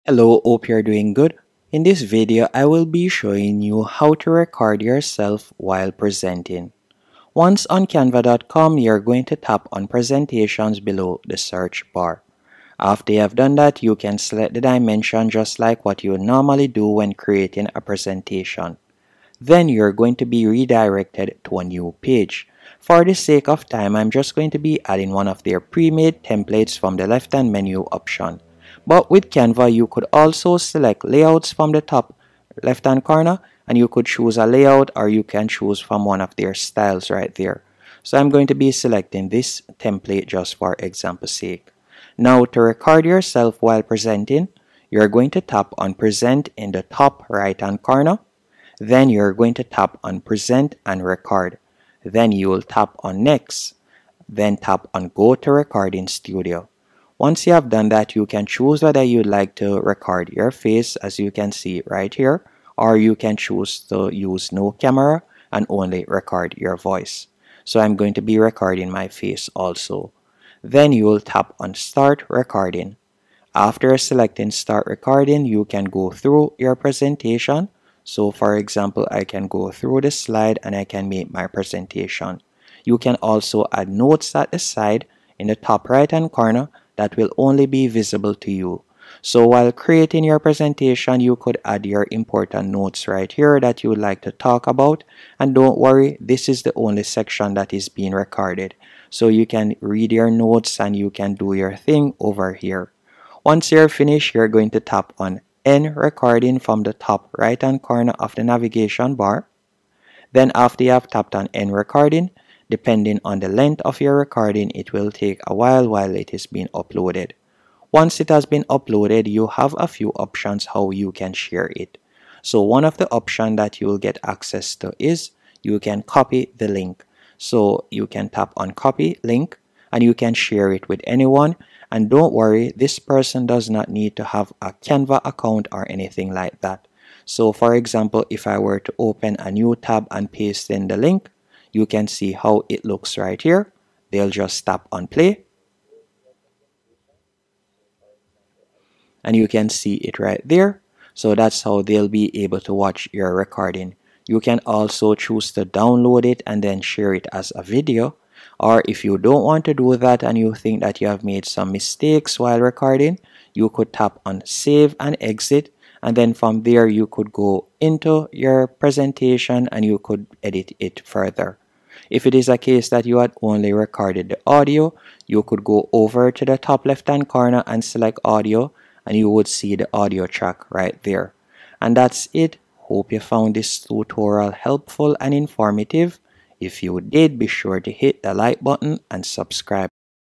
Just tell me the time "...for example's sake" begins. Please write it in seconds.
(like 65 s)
40 s.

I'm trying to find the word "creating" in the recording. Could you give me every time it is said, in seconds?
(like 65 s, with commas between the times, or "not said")
17 s, 89 s.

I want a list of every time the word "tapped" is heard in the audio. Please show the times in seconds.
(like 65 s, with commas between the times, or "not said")
111 s.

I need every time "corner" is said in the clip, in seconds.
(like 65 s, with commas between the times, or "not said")
33 s, 47 s, 86 s, 107 s, 177 s.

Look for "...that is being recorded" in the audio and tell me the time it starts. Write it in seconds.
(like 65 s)
97 s.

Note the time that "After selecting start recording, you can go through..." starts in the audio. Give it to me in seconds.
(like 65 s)
73 s.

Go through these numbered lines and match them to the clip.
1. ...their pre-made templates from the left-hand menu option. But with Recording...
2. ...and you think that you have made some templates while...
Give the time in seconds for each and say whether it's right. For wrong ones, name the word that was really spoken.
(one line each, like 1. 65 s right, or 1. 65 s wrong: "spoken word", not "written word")
1. 25 s wrong: "Canva", not "Recording"
2. 160 s wrong: "mistakes", not "templates".